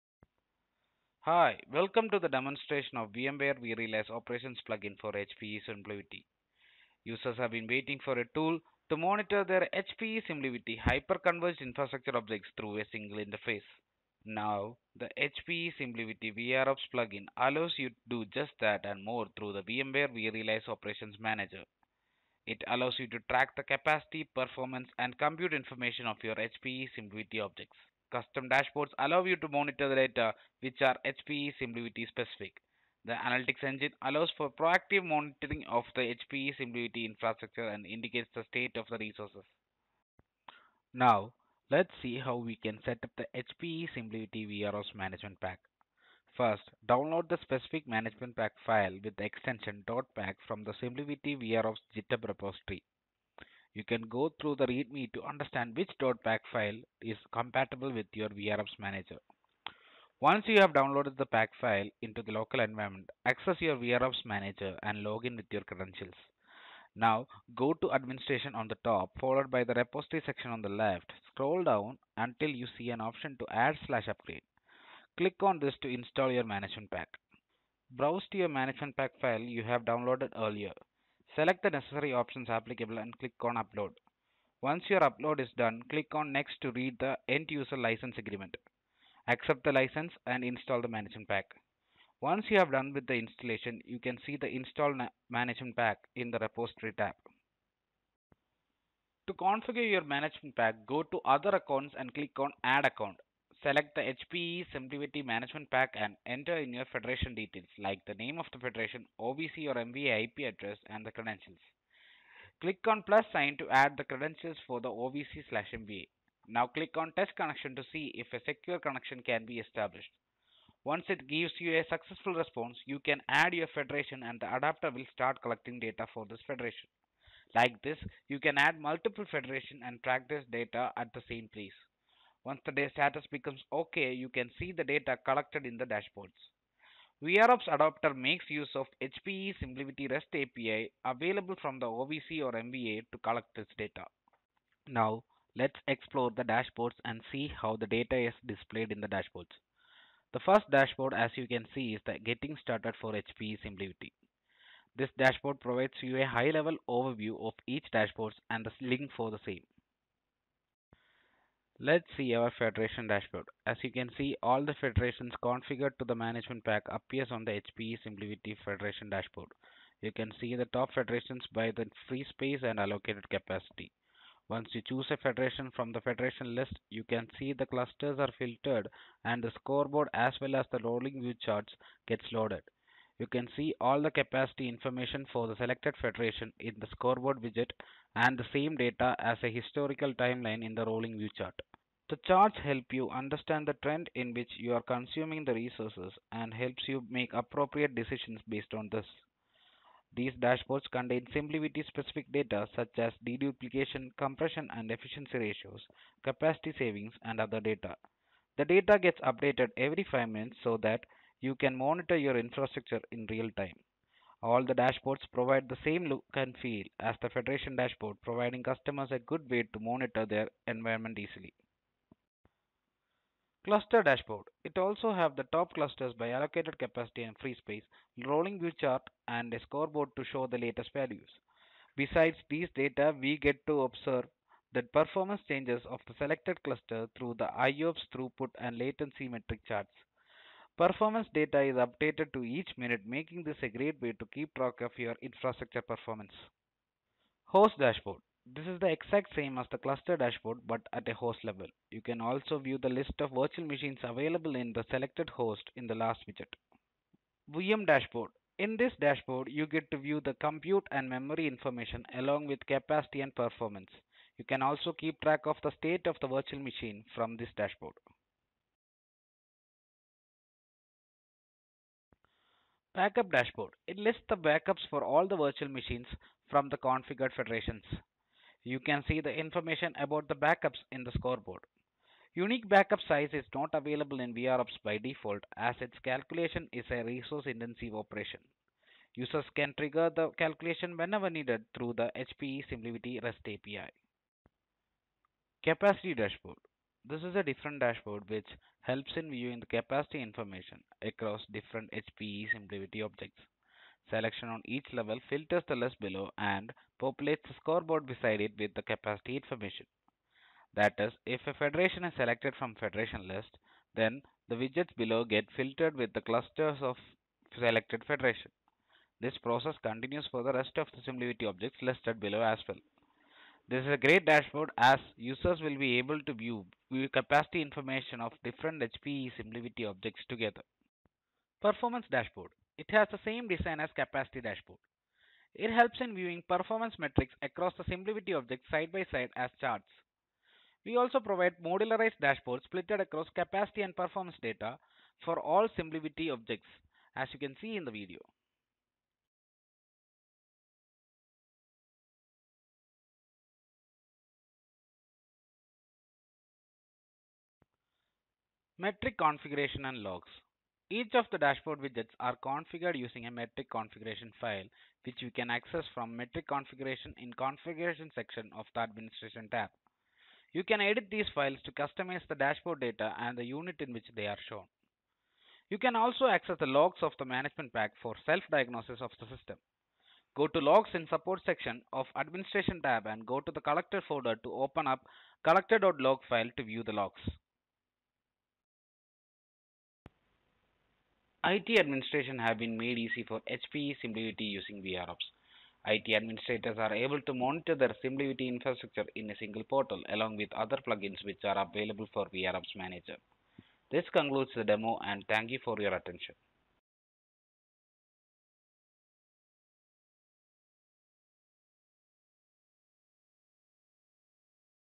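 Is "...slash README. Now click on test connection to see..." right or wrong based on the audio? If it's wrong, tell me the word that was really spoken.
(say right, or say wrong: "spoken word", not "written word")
wrong: "MVA", not "README".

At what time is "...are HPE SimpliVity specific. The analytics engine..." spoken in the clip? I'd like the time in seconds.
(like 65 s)
30 s.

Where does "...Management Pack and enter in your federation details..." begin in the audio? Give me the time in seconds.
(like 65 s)
105 s.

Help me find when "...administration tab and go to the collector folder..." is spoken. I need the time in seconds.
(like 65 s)
382 s.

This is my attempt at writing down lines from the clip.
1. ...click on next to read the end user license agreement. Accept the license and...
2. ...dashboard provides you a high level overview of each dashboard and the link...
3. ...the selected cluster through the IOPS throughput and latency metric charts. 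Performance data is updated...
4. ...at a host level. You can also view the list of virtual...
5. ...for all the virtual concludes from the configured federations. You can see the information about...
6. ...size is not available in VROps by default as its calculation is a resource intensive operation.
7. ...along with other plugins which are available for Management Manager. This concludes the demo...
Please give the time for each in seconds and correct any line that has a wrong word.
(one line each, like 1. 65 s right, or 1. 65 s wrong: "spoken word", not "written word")
1. 85 s right
2. 155 s right
3. 236 s right
4. 250 s right
5. 274 s wrong: "machines", not "concludes"
6. 283 s right
7. 400 s wrong: "VROps", not "Management".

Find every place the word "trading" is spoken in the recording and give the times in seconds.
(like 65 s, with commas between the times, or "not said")
not said.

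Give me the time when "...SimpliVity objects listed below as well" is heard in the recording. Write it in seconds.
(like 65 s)
321 s.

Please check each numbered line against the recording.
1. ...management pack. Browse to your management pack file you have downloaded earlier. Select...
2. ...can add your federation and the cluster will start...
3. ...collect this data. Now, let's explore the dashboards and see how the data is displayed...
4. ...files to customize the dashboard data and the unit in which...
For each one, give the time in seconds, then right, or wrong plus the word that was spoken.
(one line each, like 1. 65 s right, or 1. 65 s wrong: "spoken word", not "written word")
1. 76 s right
2. 122 s wrong: "adapter", not "cluster"
3. 143 s right
4. 371 s right.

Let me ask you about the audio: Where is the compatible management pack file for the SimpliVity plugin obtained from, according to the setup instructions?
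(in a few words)
GitHub repository.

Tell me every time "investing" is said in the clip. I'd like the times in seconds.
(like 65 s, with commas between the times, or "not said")
not said.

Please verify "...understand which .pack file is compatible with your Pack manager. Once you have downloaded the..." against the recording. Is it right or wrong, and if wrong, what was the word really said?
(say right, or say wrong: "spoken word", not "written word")
wrong: "VROps", not "Pack".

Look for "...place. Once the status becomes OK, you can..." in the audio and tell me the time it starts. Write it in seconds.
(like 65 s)
131 s.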